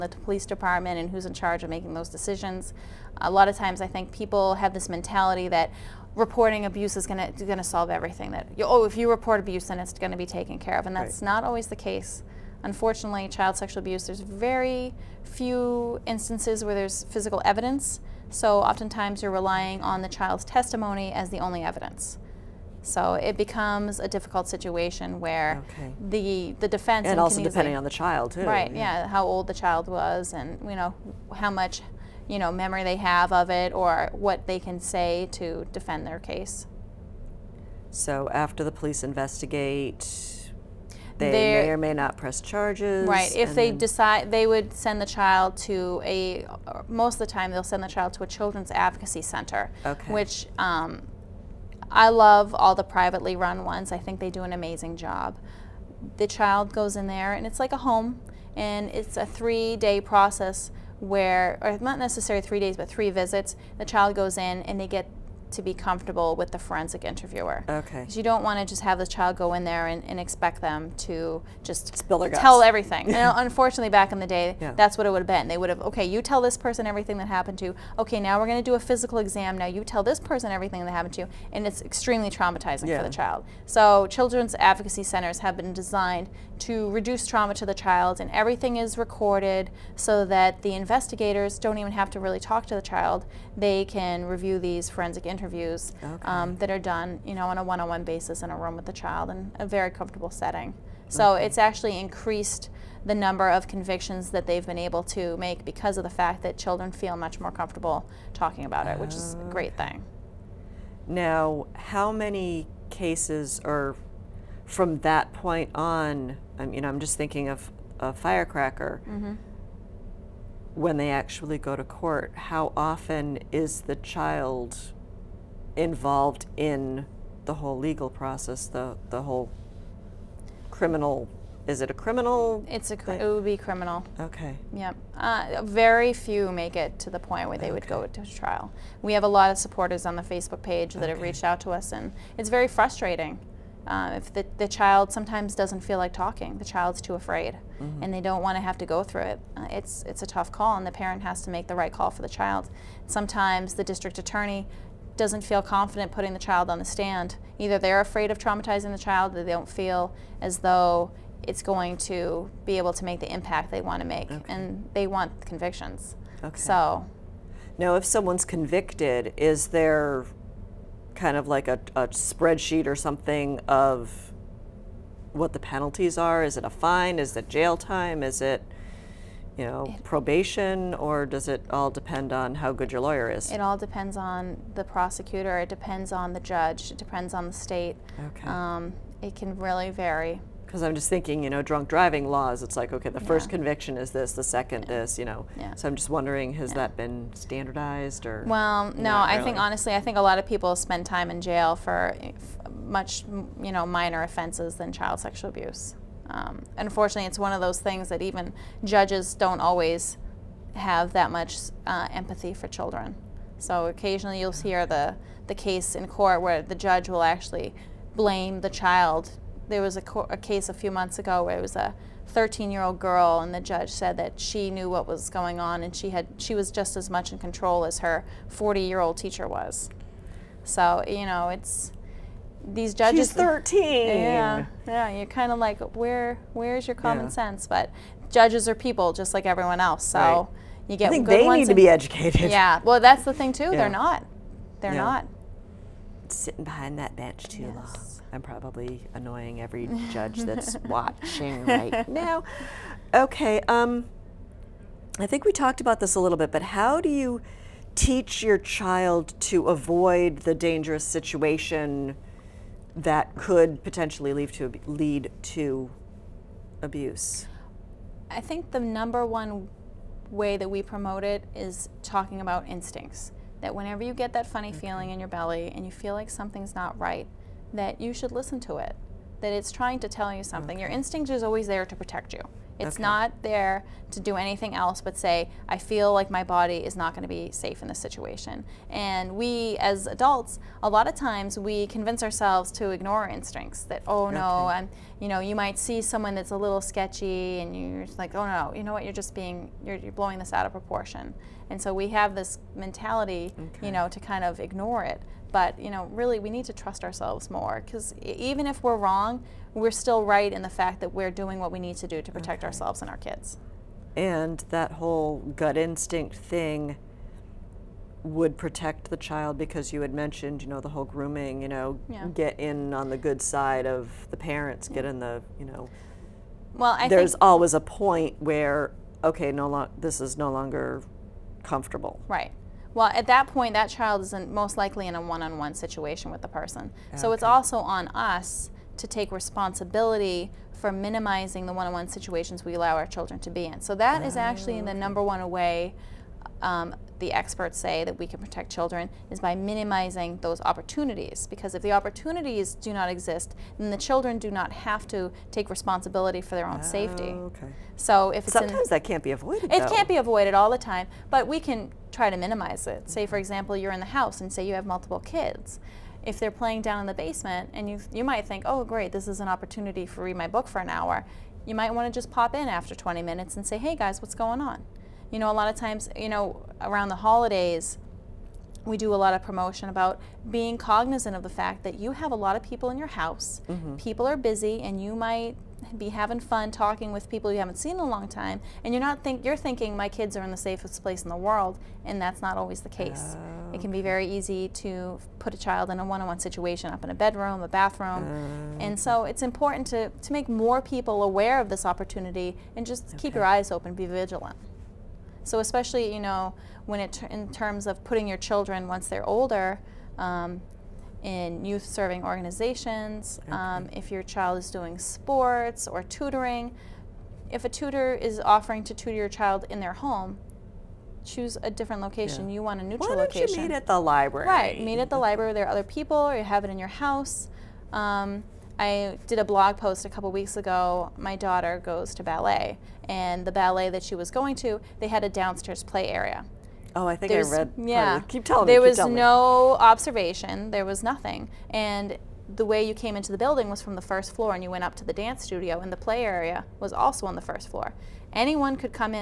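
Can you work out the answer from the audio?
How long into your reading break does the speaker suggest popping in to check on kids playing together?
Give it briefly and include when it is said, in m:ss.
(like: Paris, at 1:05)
20 minutes, at 6:12.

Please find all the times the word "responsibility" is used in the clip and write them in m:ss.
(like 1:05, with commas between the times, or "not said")
5:39, 5:55.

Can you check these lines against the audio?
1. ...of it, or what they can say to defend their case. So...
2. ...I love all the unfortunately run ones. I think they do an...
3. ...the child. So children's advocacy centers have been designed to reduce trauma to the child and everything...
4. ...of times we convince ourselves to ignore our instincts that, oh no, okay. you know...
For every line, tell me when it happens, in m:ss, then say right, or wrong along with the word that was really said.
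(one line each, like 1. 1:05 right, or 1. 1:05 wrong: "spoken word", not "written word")
1. 0:33 right
2. 0:51 wrong: "privately", not "unfortunately"
3. 1:23 right
4. 4:51 right.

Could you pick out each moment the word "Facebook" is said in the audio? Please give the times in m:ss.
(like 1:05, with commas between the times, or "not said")
2:20.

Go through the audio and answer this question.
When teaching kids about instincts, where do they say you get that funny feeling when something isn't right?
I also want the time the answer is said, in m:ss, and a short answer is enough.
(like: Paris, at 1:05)
belly, at 4:35.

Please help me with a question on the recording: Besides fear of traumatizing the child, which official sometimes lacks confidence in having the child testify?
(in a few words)
district attorney.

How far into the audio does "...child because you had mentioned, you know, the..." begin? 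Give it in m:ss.
5:19.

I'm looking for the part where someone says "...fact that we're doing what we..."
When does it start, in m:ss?
5:10.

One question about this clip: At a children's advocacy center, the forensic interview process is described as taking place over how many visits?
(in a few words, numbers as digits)
3 visits.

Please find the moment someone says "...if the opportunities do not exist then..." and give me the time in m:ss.
5:51.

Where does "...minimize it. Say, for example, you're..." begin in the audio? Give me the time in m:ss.
6:02.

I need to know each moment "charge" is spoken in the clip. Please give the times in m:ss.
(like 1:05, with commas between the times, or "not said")
0:01, 0:42.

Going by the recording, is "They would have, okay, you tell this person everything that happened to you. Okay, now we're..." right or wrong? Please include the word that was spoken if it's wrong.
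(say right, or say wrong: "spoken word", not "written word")
right.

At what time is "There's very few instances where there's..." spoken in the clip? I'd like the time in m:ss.
0:14.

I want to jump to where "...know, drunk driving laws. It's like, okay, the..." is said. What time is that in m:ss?
3:11.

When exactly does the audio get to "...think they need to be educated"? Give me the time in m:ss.
4:01.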